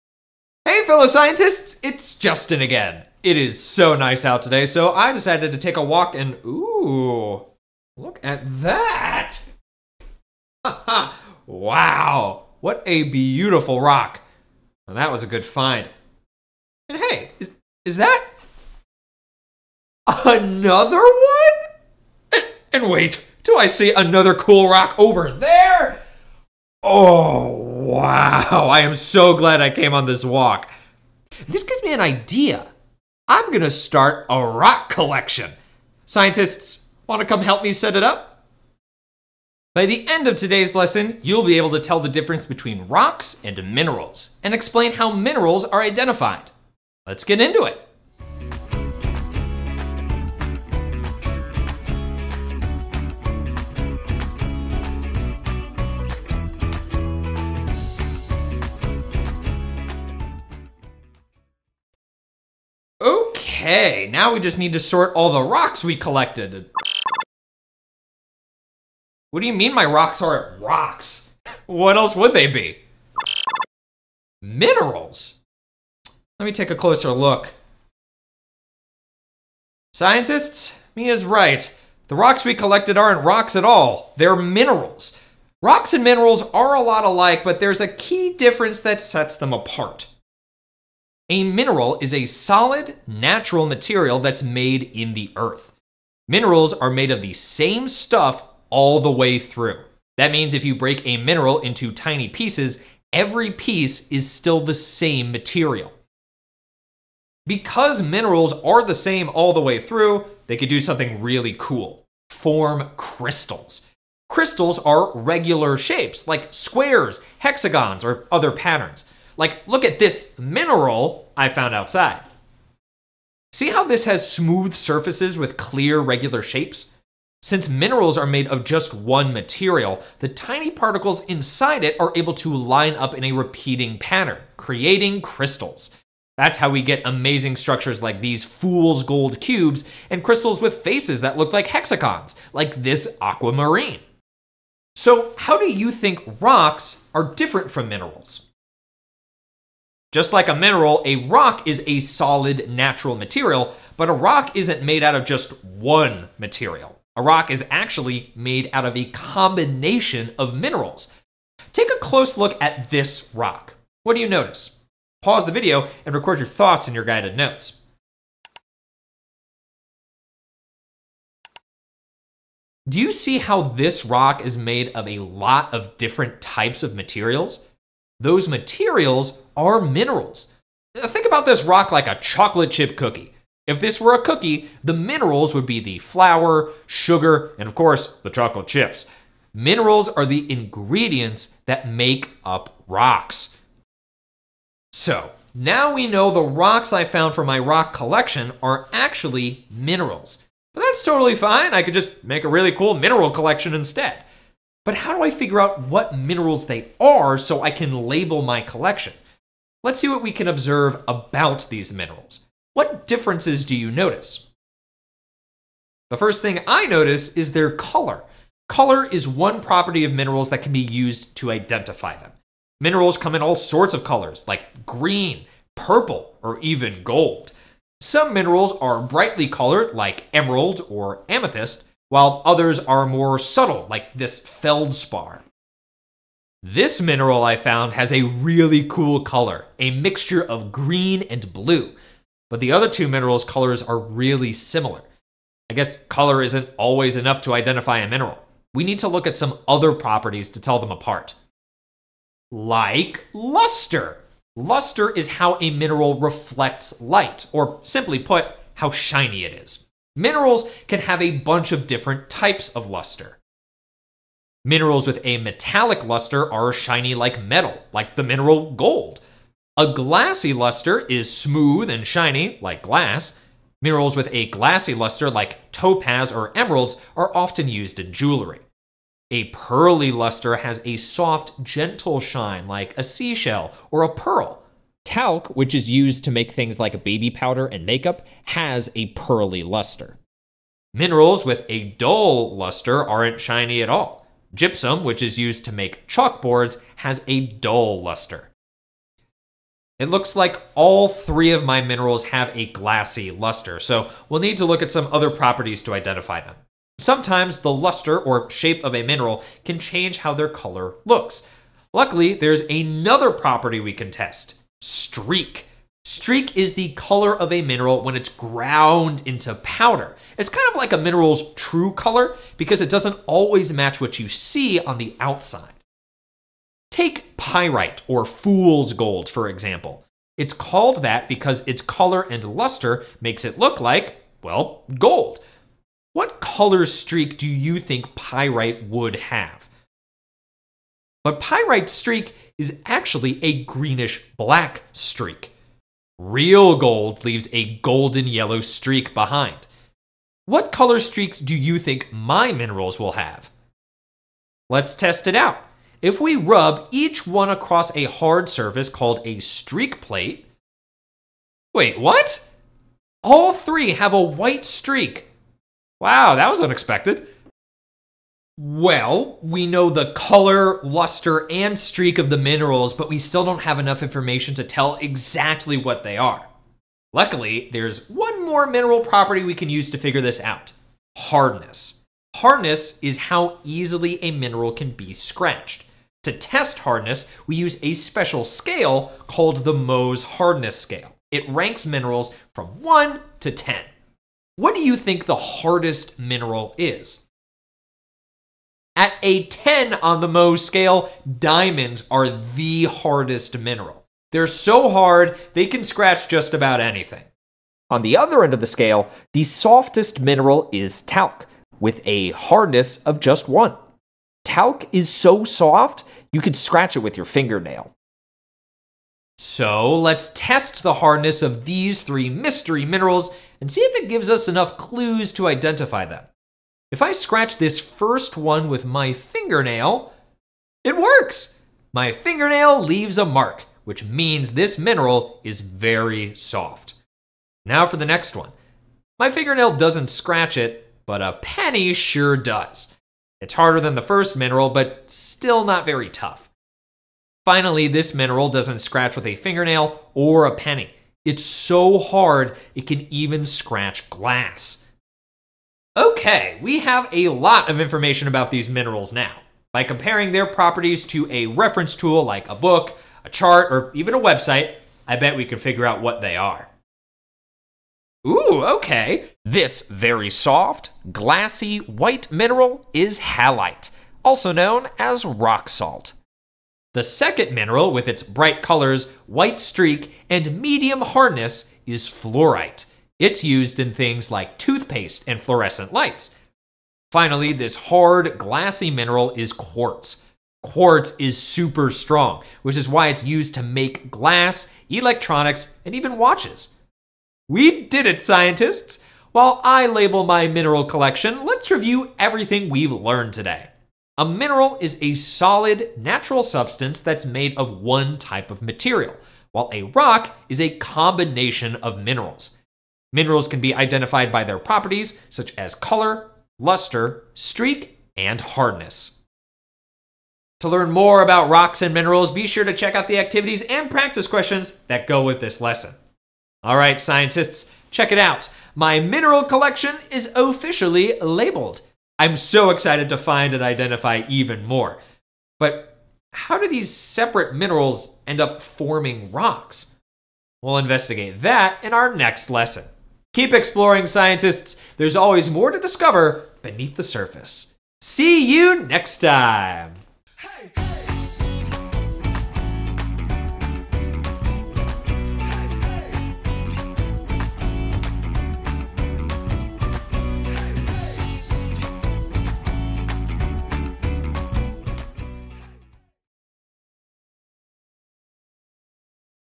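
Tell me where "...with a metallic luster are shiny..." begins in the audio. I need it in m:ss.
4:25.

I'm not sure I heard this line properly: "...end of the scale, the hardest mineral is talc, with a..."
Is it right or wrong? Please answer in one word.
wrong.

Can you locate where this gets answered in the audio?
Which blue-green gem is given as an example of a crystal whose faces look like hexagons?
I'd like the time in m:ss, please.
2:23.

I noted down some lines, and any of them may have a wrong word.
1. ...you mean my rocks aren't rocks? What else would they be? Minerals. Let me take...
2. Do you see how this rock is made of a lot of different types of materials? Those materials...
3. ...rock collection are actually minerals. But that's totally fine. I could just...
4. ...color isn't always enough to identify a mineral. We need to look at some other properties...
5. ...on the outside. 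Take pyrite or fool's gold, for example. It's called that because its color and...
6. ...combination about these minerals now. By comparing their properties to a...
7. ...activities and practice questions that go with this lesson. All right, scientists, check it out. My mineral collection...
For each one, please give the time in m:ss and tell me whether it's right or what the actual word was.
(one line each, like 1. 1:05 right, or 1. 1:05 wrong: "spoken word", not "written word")
1. 1:09 right
2. 2:52 right
3. 3:17 right
4. 4:06 right
5. 5:24 right
6. 7:37 wrong: "information", not "combination"
7. 8:43 right.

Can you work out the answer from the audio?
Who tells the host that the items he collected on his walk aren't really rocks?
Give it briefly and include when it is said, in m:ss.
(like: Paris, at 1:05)
Mia, at 1:20.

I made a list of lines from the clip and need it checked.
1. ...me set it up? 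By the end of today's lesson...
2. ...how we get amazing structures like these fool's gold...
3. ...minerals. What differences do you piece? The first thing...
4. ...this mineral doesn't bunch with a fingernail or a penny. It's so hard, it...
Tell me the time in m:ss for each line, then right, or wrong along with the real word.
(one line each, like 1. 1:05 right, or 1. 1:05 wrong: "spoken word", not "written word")
1. 0:37 right
2. 2:16 right
3. 3:31 wrong: "notice", not "piece"
4. 7:27 wrong: "scratch", not "bunch".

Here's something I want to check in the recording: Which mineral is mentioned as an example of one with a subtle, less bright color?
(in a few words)
feldspar.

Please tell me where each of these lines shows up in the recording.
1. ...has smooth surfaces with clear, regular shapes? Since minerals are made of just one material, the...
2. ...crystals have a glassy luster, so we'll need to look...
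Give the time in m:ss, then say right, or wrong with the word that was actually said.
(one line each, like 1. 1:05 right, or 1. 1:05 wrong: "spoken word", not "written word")
1. 2:04 right
2. 5:01 wrong: "minerals", not "crystals".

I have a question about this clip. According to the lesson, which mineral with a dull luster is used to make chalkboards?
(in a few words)
gypsum.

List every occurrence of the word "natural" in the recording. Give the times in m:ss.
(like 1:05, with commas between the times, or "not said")
1:33, 2:32, 8:25.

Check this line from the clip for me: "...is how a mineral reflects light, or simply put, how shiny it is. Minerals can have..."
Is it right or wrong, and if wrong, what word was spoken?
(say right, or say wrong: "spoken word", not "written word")
right.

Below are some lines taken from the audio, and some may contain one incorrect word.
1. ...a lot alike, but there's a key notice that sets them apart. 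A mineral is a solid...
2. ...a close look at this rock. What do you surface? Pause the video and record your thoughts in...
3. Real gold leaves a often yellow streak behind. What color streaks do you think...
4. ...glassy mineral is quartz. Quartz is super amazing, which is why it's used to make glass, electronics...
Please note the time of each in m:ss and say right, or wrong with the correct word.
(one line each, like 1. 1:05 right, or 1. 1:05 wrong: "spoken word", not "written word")
1. 1:26 wrong: "difference", not "notice"
2. 2:41 wrong: "notice", not "surface"
3. 5:46 wrong: "golden", not "often"
4. 8:08 wrong: "strong", not "amazing".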